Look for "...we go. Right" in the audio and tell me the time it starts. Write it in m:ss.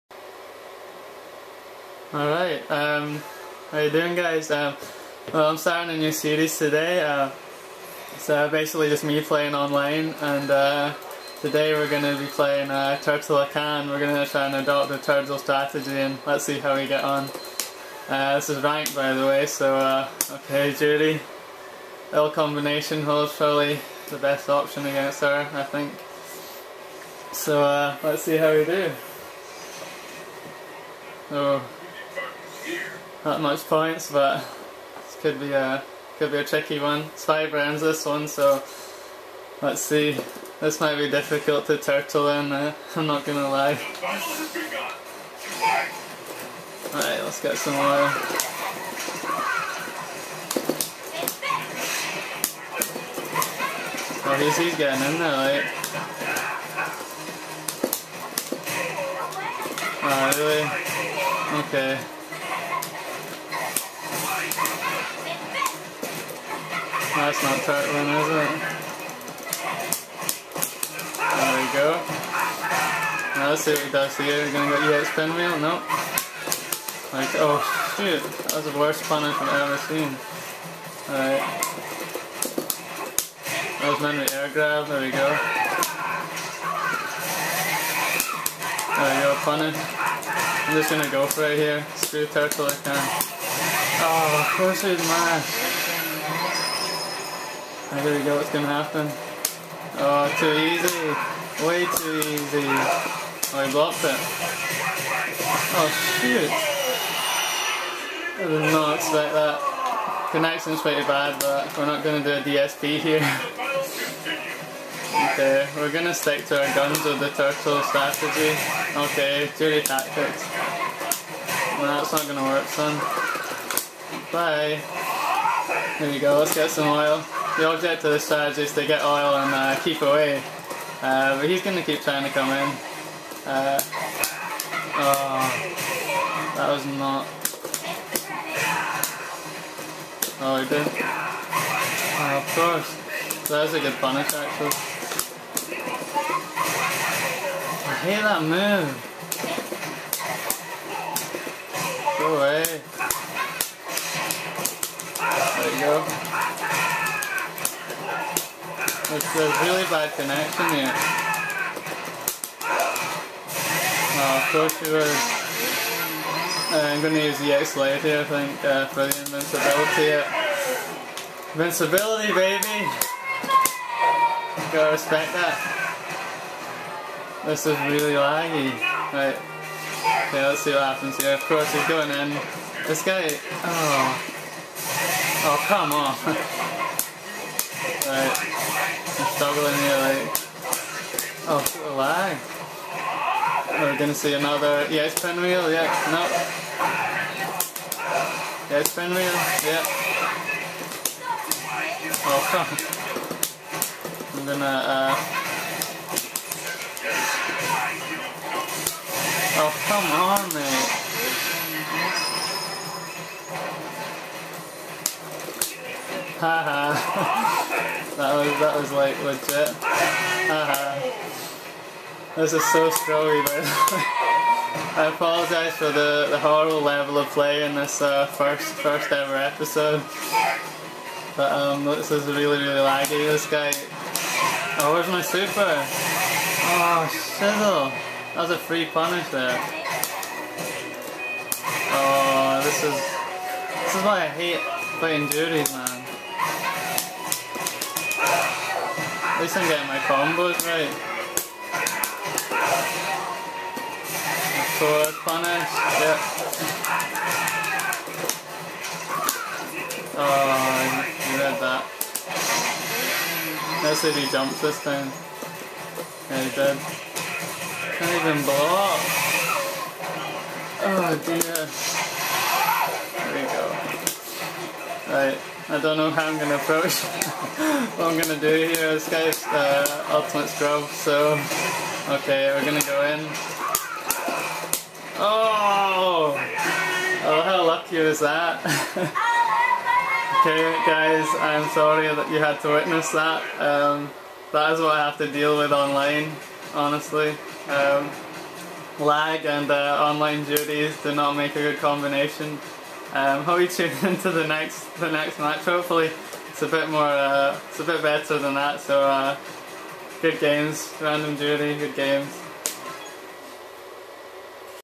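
4:33.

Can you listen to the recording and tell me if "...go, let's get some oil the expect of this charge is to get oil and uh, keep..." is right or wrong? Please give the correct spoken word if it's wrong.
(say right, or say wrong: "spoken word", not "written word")
wrong: "object", not "expect".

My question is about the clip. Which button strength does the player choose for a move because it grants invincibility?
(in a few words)
X light.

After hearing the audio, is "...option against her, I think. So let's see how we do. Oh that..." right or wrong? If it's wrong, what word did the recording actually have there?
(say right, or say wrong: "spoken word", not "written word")
right.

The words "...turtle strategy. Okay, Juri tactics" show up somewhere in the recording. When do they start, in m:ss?
1:57.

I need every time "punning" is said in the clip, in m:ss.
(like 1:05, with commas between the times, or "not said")
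1:29.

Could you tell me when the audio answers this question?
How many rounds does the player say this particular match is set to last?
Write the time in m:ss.
0:37.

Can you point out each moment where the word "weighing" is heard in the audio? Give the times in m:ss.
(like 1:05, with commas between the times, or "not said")
not said.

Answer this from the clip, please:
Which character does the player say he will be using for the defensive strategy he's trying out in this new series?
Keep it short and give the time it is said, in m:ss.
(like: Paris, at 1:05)
Hakan, at 0:13.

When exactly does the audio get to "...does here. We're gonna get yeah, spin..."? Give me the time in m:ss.
1:13.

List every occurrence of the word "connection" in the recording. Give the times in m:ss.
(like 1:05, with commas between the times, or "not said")
1:50, 2:40.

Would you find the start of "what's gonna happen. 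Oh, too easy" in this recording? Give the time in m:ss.
1:38.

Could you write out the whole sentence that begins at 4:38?
This guy's uh, ultimate scrub, so okay, we're going to go in.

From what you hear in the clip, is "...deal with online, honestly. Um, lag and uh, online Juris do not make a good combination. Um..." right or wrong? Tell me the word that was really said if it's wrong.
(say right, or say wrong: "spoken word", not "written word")
right.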